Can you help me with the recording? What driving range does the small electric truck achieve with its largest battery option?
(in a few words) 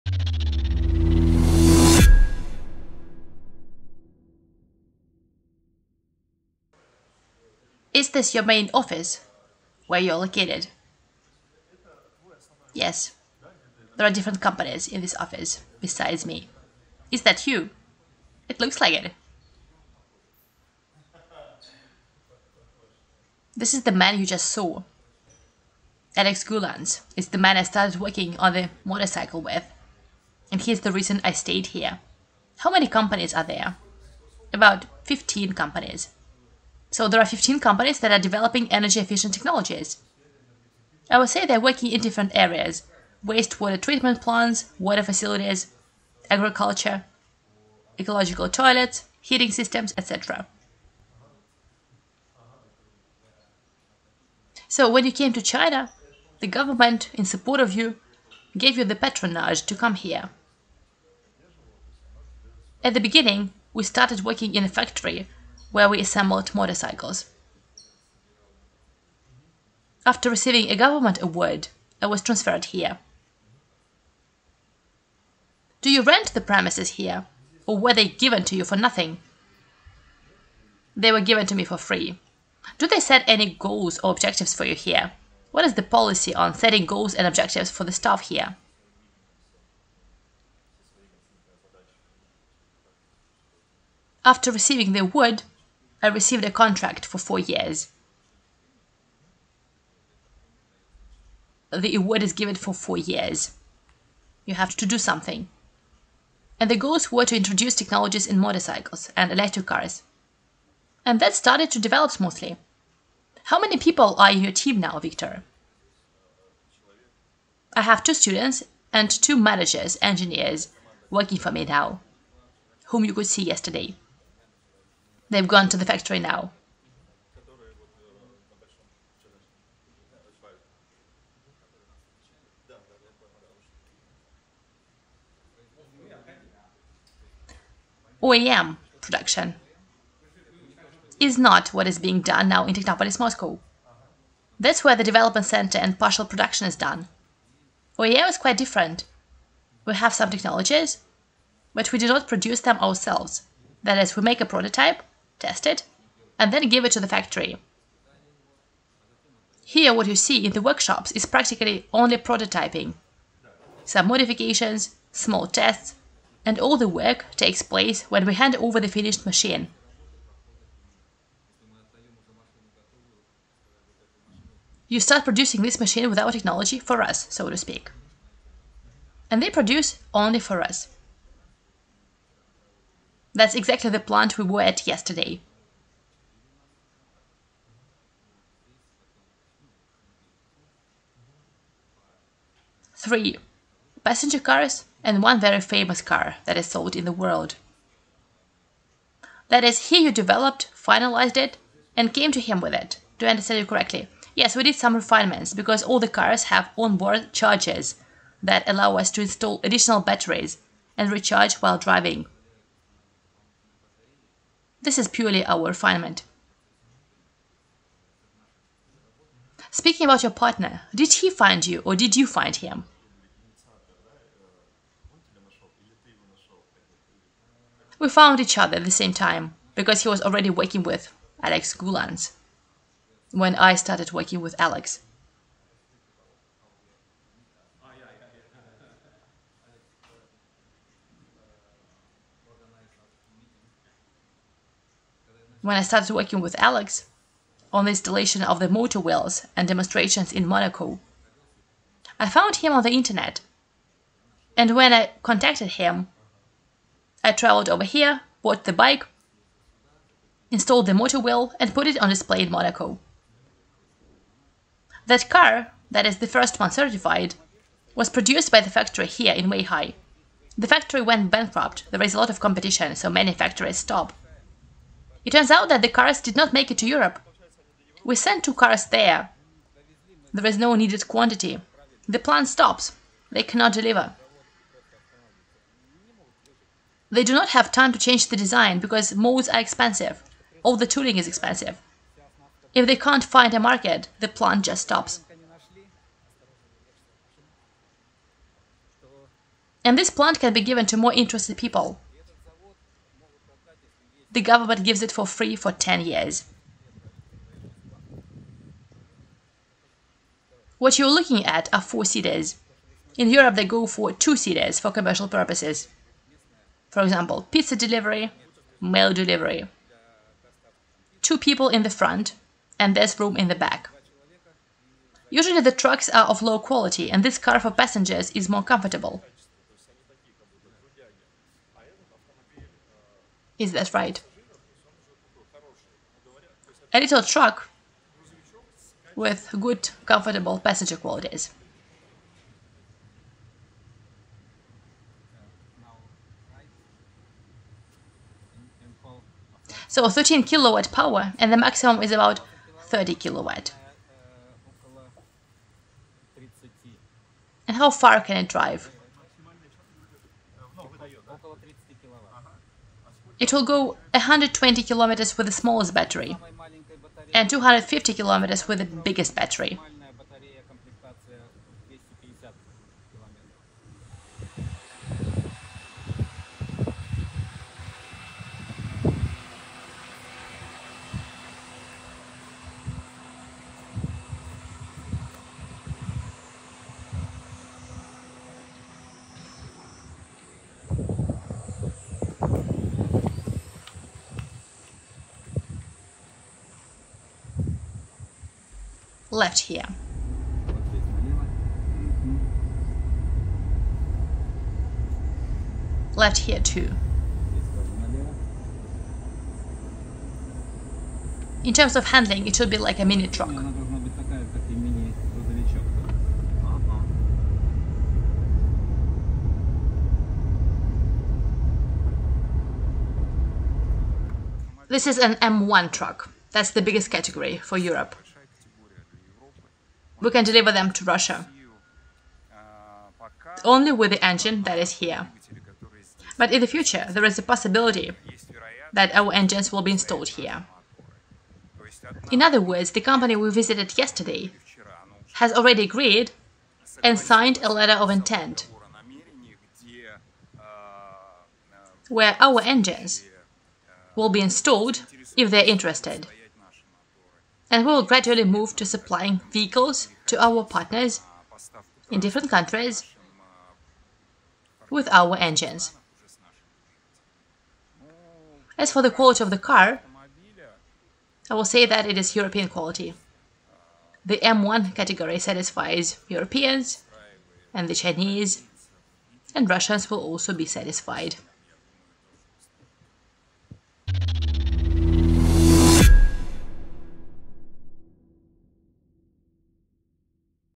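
250 kilometers.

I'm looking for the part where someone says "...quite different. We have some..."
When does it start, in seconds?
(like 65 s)
148 s.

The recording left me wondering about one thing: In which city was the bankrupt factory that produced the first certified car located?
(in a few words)
Weihai.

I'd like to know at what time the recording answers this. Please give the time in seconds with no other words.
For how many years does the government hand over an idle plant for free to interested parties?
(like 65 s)
305 s.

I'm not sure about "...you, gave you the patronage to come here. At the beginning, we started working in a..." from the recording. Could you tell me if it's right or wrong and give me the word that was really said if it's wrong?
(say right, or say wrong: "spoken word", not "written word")
right.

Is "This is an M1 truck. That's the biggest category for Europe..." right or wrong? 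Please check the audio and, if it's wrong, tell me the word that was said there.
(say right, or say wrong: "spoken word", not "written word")
right.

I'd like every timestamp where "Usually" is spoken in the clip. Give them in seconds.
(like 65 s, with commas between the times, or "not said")
325 s.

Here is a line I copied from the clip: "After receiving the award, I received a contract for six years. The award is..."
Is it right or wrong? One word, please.
wrong.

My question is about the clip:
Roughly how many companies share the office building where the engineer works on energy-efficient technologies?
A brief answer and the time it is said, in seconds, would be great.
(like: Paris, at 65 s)
15, at 34 s.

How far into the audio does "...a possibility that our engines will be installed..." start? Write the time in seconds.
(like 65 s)
437 s.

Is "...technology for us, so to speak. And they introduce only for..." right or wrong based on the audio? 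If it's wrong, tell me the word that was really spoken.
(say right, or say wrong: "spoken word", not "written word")
wrong: "produce", not "introduce".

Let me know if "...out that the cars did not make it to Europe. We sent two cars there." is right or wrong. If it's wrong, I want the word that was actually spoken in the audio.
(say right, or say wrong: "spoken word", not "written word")
right.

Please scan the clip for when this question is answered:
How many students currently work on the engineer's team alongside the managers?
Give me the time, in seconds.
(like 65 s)
118 s.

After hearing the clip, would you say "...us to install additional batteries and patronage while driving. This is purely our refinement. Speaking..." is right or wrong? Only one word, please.
wrong.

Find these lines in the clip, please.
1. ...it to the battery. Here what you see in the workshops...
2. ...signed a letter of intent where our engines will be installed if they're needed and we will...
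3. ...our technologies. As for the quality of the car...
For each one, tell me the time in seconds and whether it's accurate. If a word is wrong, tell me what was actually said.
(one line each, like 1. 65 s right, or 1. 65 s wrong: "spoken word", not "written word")
1. 156 s wrong: "factory", not "battery"
2. 447 s wrong: "interested", not "needed"
3. 465 s wrong: "engines", not "technologies".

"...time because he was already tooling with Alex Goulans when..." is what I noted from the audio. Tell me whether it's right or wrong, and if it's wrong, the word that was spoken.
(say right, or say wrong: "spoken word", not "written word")
wrong: "working", not "tooling".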